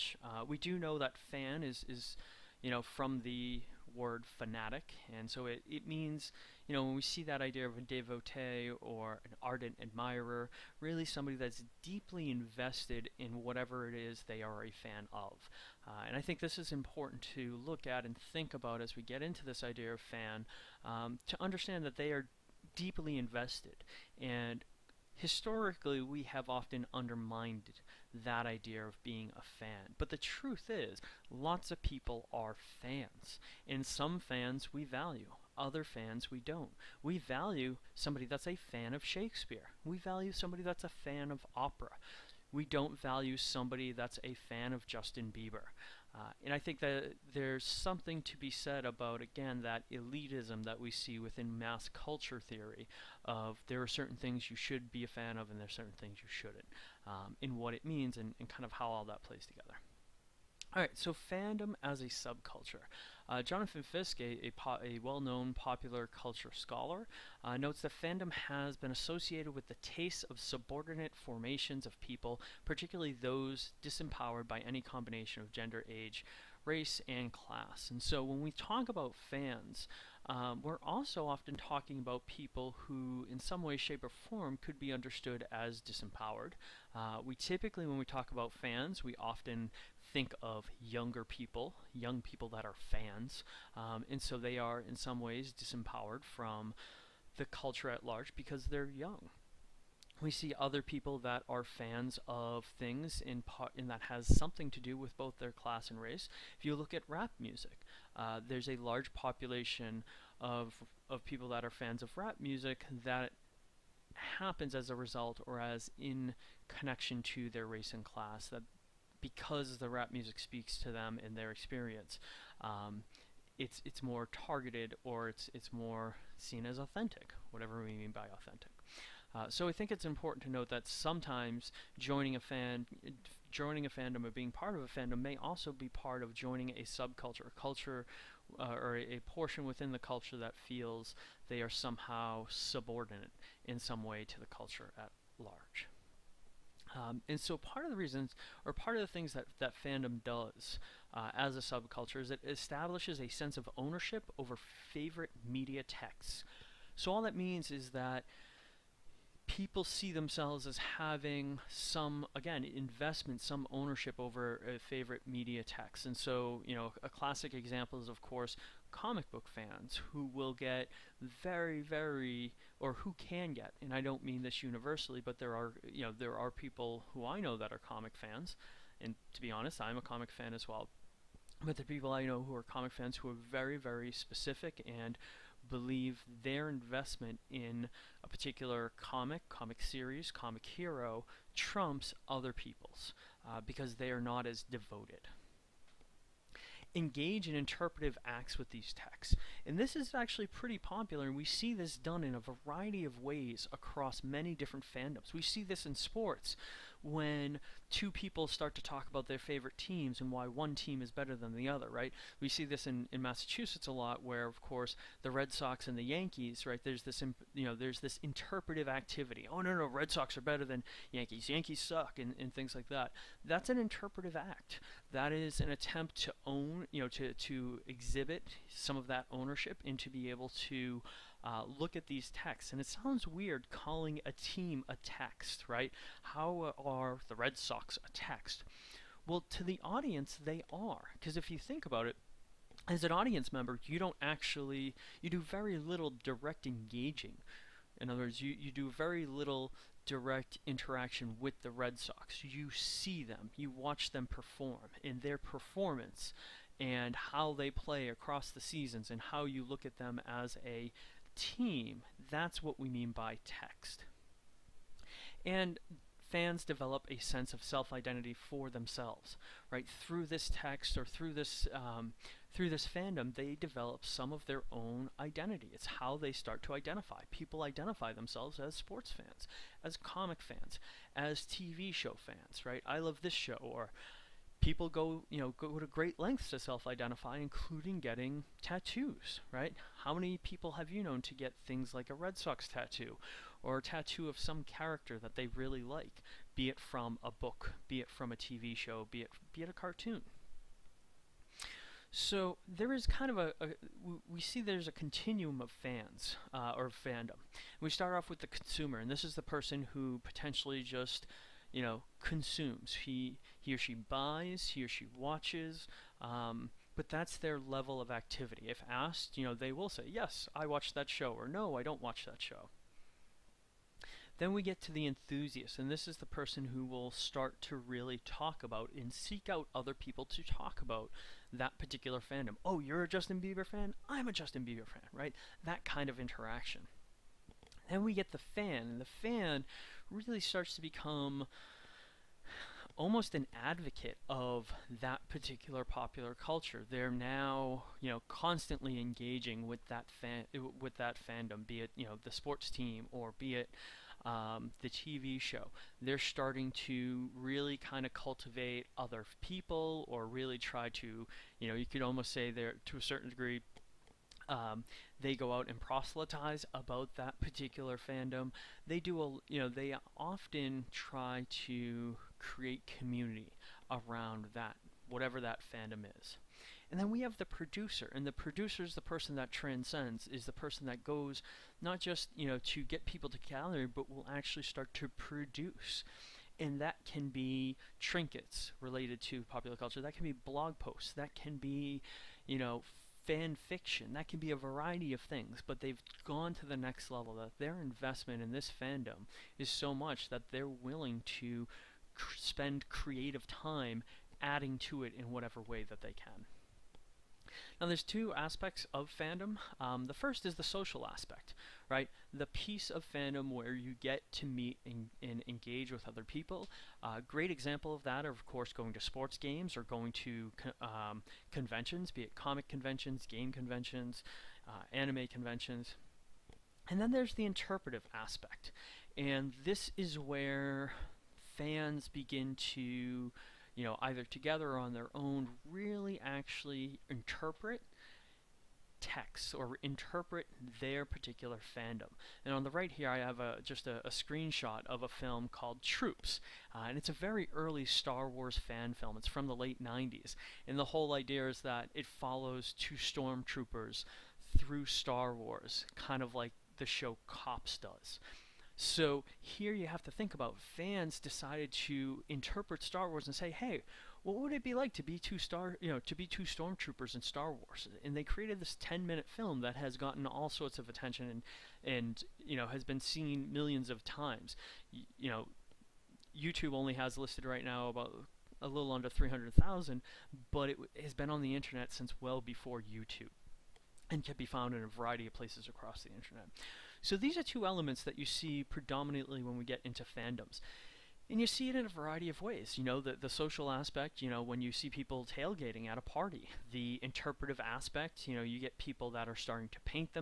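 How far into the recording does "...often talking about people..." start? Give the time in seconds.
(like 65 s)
81 s.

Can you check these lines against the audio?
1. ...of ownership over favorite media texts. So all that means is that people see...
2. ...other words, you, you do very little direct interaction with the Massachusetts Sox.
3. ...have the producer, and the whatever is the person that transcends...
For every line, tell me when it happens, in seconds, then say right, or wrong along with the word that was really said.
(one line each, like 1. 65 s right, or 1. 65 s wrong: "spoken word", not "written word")
1. 153 s right
2. 248 s wrong: "Red", not "Massachusetts"
3. 377 s wrong: "producer", not "whatever".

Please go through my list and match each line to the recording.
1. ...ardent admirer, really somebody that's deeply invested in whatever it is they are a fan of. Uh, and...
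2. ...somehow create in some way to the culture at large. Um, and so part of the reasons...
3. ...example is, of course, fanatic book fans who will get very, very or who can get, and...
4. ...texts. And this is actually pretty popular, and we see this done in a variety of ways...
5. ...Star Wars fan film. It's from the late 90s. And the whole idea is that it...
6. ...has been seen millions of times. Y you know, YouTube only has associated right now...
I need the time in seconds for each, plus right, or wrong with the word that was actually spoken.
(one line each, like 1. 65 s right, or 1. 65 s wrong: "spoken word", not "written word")
1. 9 s right
2. 141 s wrong: "subordinate", not "create"
3. 167 s wrong: "comic", not "fanatic"
4. 198 s right
5. 447 s right
6. 472 s wrong: "listed", not "associated".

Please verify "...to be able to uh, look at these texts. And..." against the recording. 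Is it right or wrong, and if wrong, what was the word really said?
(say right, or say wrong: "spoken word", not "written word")
right.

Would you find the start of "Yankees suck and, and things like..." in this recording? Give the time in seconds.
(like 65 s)
221 s.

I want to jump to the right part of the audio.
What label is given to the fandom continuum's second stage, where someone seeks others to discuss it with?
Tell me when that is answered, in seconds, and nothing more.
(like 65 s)
325 s.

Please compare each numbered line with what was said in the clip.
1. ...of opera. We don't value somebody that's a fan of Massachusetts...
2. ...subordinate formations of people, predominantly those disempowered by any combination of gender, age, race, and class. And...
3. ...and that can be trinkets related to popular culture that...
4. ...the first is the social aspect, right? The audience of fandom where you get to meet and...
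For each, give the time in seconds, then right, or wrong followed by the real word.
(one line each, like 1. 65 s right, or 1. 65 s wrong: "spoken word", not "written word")
1. 41 s wrong: "Justin", not "Massachusetts"
2. 70 s wrong: "particularly", not "predominantly"
3. 386 s right
4. 410 s wrong: "piece", not "audience".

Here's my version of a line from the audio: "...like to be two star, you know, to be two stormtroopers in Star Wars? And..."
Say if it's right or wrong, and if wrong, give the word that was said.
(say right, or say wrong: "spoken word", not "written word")
right.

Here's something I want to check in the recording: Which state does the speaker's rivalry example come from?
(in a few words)
Massachusetts.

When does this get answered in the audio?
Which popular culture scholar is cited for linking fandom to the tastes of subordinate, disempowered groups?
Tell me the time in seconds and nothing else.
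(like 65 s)
63 s.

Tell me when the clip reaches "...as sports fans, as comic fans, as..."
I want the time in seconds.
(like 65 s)
278 s.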